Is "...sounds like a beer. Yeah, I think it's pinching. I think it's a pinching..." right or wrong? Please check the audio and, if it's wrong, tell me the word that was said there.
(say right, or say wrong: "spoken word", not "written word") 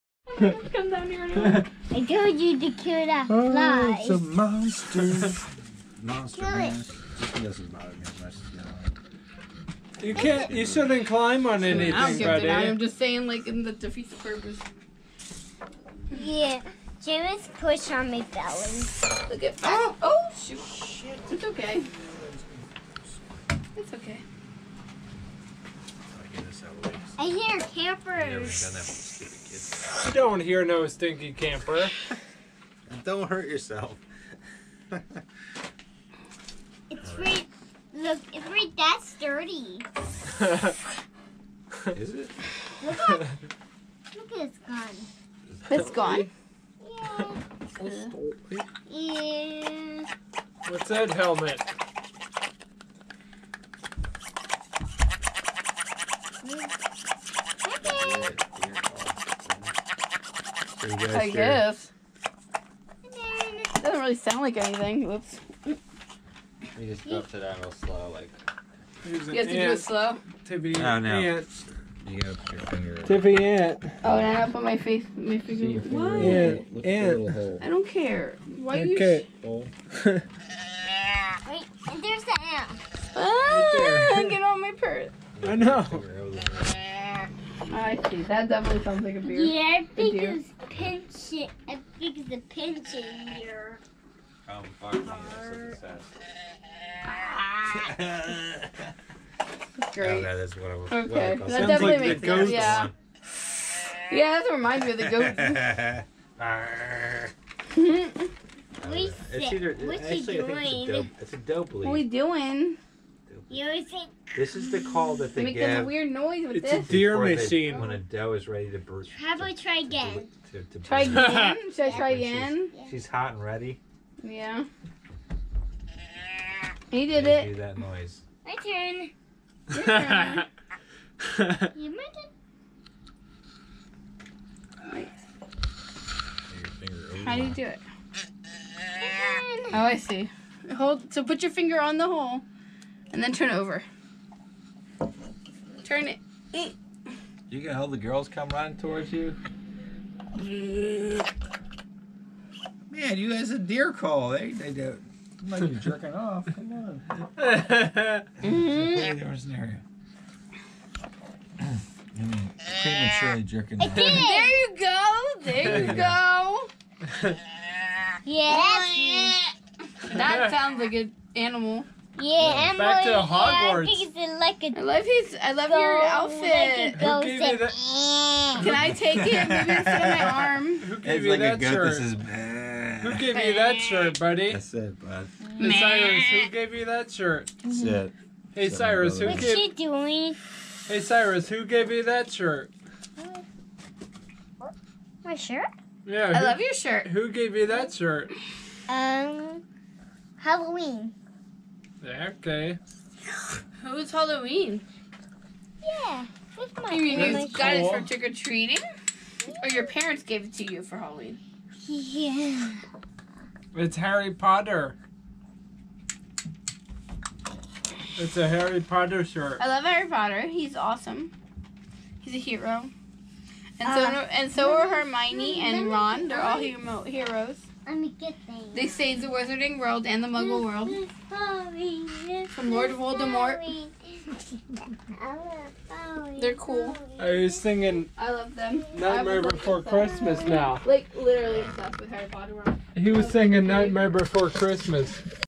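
right.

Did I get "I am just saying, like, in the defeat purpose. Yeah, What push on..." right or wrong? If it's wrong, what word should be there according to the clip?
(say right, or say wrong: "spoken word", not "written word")
wrong: "James", not "What".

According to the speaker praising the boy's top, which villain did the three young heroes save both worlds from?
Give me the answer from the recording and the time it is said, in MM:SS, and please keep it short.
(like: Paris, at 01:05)
Lord Voldemort, at 03:52.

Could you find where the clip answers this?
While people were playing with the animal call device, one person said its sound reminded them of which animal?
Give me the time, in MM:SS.
01:45.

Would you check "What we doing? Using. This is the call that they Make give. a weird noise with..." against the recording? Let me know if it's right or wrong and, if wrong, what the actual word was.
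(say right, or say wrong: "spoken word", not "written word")
right.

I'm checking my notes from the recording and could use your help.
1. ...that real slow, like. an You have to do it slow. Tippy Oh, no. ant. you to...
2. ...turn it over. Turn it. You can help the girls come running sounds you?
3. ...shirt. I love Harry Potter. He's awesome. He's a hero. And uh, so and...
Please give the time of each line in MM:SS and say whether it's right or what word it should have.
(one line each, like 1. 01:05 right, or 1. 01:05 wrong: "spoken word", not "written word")
1. 01:07 right
2. 02:23 wrong: "towards", not "sounds"
3. 03:39 right.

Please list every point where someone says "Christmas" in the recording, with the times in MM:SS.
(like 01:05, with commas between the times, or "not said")
03:59, 04:04.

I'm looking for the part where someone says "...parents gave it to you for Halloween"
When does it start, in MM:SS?
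03:29.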